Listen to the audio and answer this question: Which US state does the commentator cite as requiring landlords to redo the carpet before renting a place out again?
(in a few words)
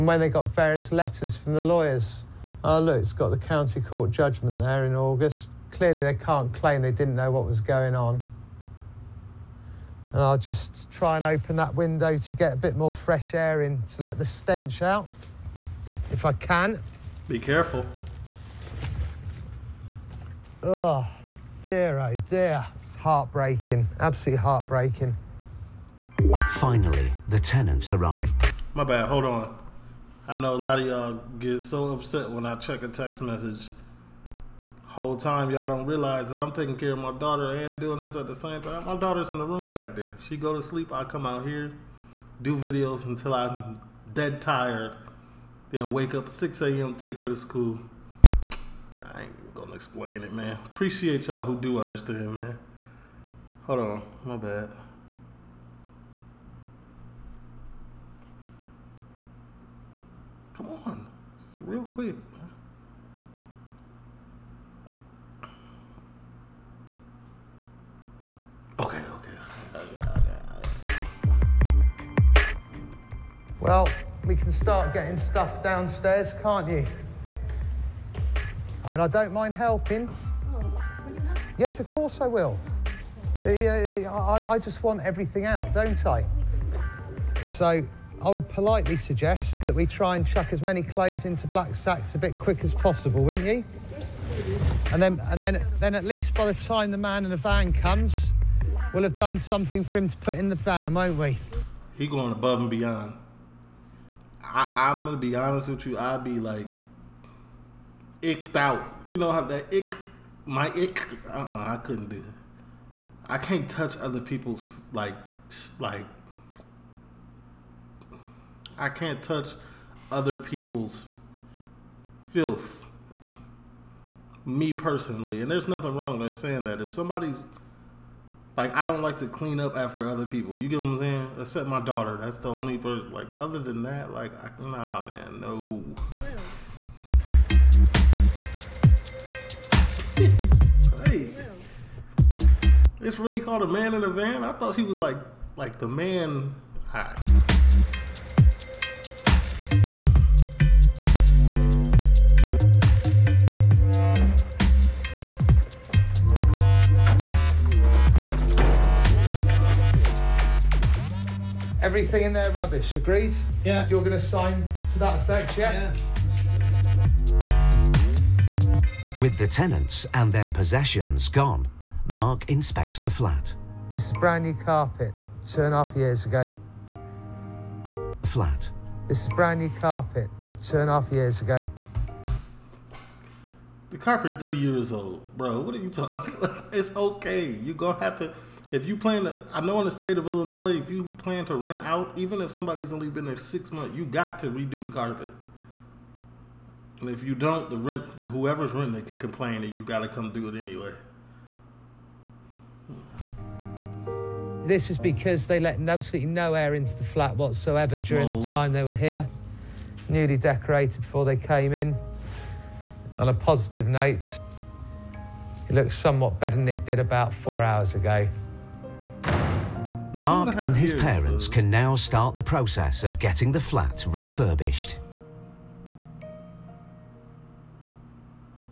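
Illinois.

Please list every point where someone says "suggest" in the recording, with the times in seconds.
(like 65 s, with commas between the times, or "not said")
88 s.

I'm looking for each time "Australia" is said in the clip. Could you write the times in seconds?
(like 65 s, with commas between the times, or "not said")
not said.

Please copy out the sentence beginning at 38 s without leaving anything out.
My daughter's in the room back there.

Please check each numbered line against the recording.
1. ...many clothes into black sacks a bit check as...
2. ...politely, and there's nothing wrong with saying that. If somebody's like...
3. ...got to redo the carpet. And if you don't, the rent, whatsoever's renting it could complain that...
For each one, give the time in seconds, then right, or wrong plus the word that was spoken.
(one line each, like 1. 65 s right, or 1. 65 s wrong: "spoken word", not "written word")
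1. 90 s wrong: "quick", not "check"
2. 124 s wrong: "personally", not "politely"
3. 194 s wrong: "whoever", not "whatsoever".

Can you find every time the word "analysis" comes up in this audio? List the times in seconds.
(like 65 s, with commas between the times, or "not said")
not said.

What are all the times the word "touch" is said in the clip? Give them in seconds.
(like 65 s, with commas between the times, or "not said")
113 s, 119 s.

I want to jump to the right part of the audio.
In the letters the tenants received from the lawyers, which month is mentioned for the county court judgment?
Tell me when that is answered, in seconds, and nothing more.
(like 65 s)
4 s.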